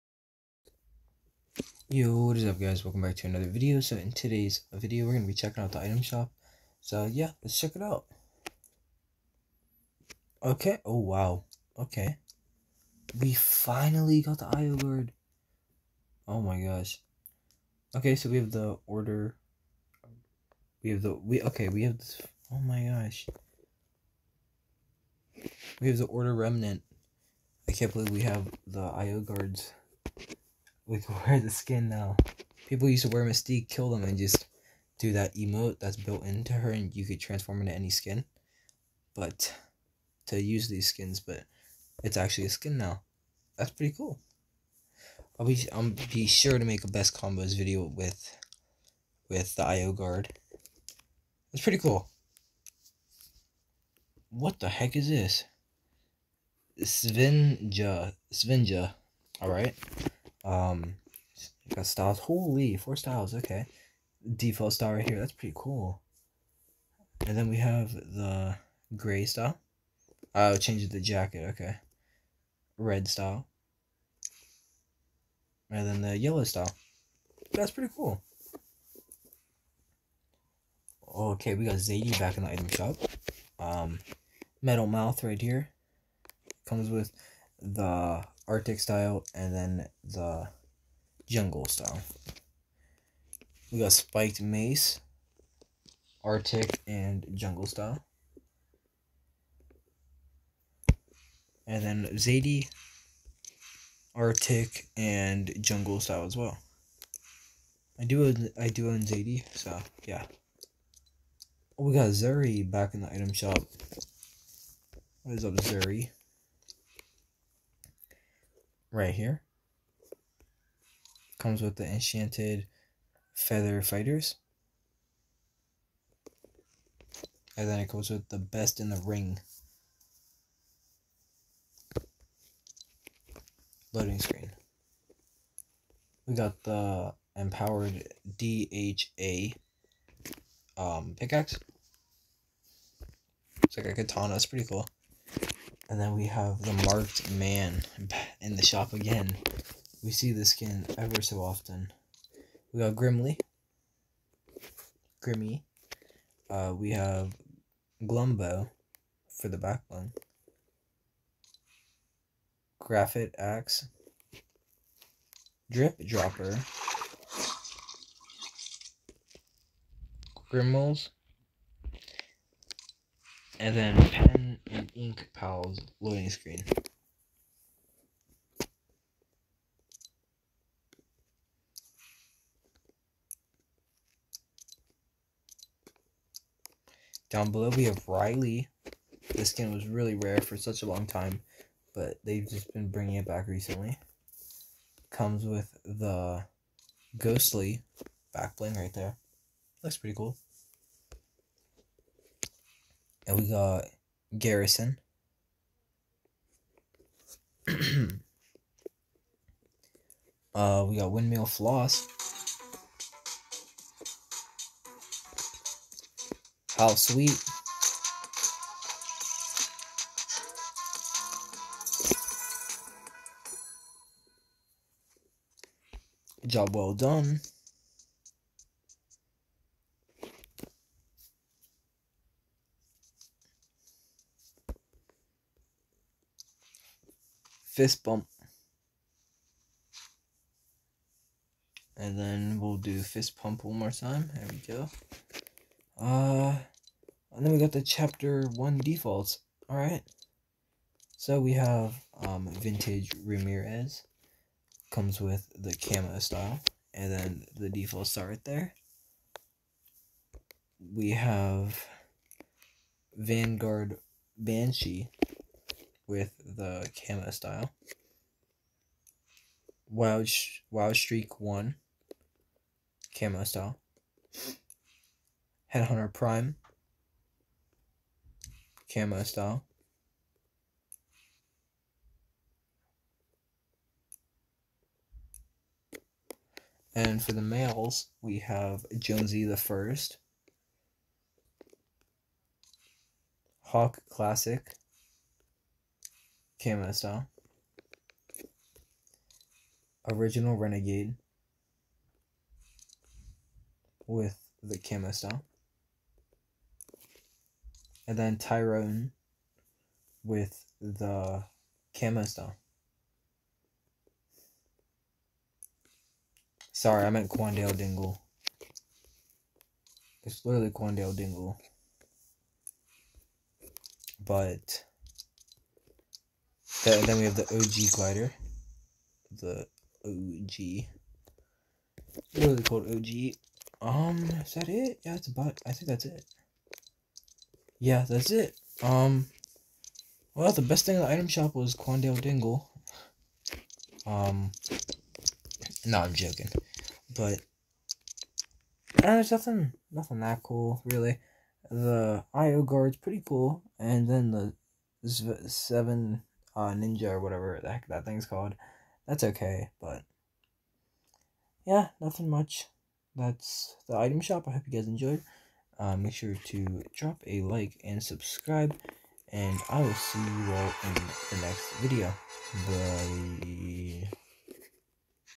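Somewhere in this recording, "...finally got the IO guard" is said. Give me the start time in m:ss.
0:13.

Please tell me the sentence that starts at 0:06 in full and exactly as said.
So yeah, let's check it out.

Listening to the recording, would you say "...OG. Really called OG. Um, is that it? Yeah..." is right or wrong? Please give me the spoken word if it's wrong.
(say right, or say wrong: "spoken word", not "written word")
right.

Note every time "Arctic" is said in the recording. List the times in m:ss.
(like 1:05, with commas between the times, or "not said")
1:28, 1:36, 1:44.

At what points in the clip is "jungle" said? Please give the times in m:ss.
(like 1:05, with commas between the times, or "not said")
1:31, 1:37, 1:45.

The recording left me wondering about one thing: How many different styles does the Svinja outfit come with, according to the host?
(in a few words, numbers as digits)
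4.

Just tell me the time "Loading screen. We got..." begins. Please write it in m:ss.
2:13.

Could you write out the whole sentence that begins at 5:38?
Um, well, the best thing in the item shop was Quandale Dingle.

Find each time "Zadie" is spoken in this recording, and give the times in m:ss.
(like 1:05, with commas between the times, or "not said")
1:21, 1:42, 1:49.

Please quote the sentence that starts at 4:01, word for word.
And then we'll do fist pump one more time.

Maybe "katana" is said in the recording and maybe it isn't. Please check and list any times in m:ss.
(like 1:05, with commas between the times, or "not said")
2:23.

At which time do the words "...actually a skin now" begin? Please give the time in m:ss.
0:42.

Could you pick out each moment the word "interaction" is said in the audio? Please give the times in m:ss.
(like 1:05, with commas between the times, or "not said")
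not said.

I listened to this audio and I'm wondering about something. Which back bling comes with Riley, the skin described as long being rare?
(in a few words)
Ghostly.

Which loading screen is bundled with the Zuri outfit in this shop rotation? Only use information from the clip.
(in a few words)
Best in the Ring.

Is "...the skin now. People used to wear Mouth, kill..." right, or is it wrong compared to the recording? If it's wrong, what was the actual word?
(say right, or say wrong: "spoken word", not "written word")
wrong: "Mystique", not "Mouth".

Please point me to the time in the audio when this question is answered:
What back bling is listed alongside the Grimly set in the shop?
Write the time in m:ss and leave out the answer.
2:38.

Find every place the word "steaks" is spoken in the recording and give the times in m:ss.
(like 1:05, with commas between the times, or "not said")
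not said.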